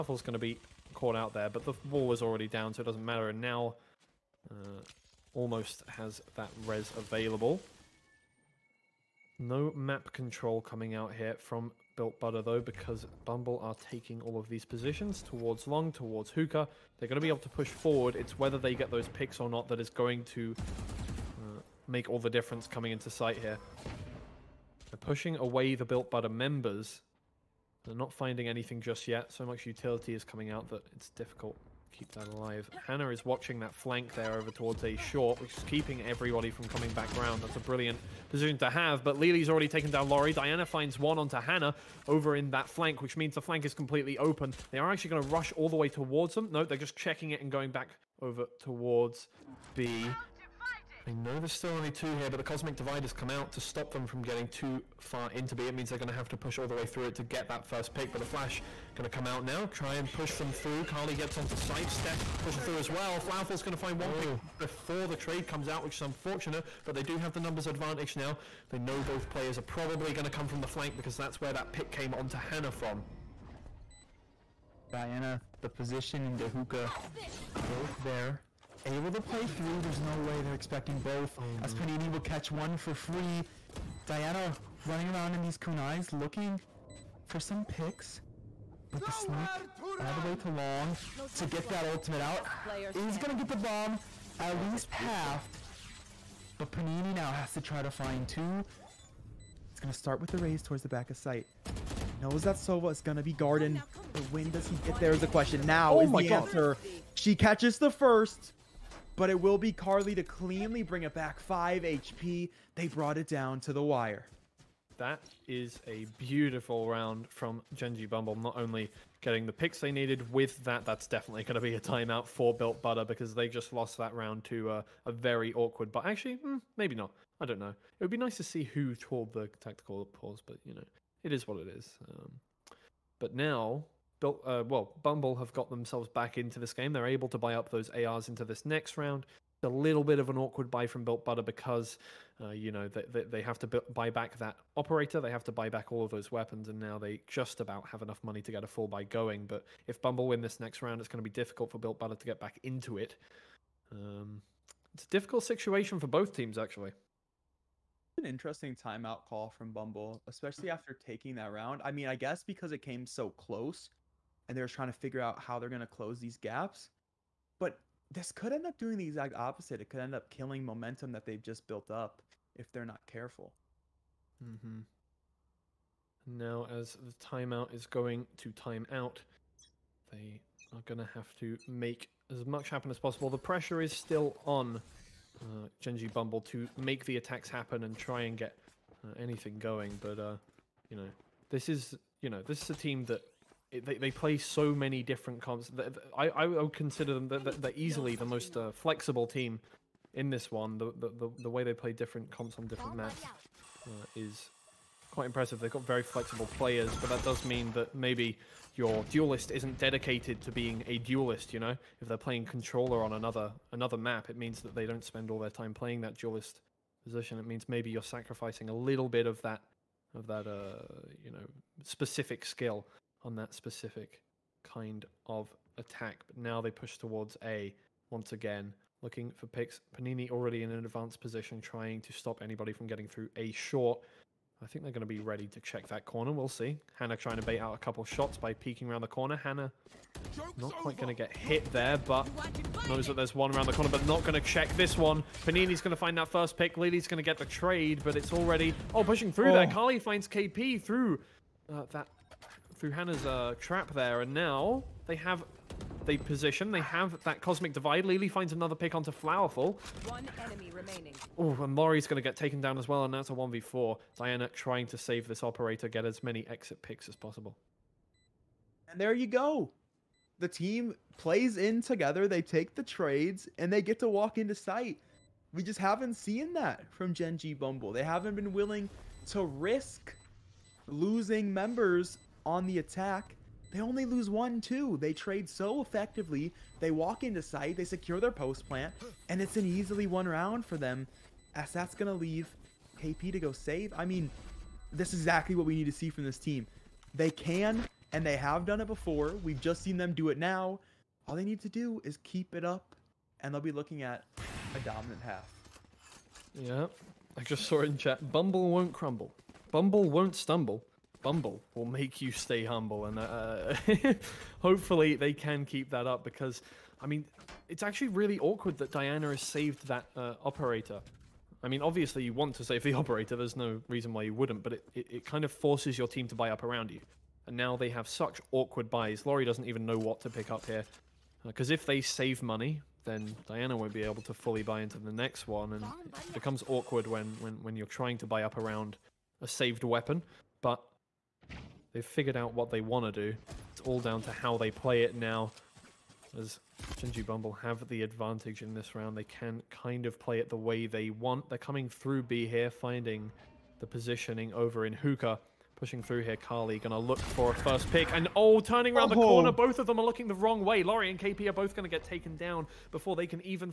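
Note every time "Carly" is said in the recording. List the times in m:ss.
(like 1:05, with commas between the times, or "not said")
1:00, 1:49, 4:09, 5:56.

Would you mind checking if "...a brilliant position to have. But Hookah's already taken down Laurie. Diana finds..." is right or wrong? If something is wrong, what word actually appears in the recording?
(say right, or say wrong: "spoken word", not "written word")
wrong: "Lily", not "Hookah".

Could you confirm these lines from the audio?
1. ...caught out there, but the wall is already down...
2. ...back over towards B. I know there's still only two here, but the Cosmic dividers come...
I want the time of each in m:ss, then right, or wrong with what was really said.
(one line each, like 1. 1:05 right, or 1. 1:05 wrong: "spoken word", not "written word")
1. 0:00 right
2. 0:47 right.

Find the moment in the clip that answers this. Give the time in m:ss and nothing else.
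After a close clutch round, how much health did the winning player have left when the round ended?
1:51.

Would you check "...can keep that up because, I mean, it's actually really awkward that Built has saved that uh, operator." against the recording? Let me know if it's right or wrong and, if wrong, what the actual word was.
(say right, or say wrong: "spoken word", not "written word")
wrong: "Diana", not "Built".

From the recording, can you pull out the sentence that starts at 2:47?
But this could end up doing the exact opposite.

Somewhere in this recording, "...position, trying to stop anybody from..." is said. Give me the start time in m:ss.
3:51.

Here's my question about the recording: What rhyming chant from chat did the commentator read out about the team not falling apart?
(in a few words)
Bumble won't crumble.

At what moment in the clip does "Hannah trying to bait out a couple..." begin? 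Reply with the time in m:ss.
3:56.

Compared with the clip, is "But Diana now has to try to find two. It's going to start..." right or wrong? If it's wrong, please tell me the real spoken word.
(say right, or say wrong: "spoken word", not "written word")
wrong: "Panini", not "Diana".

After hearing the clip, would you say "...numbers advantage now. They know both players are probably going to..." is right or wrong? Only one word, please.
right.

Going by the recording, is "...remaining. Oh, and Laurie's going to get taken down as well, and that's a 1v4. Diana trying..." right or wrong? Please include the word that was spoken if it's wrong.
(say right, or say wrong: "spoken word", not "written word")
right.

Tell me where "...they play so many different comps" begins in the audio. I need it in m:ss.
3:13.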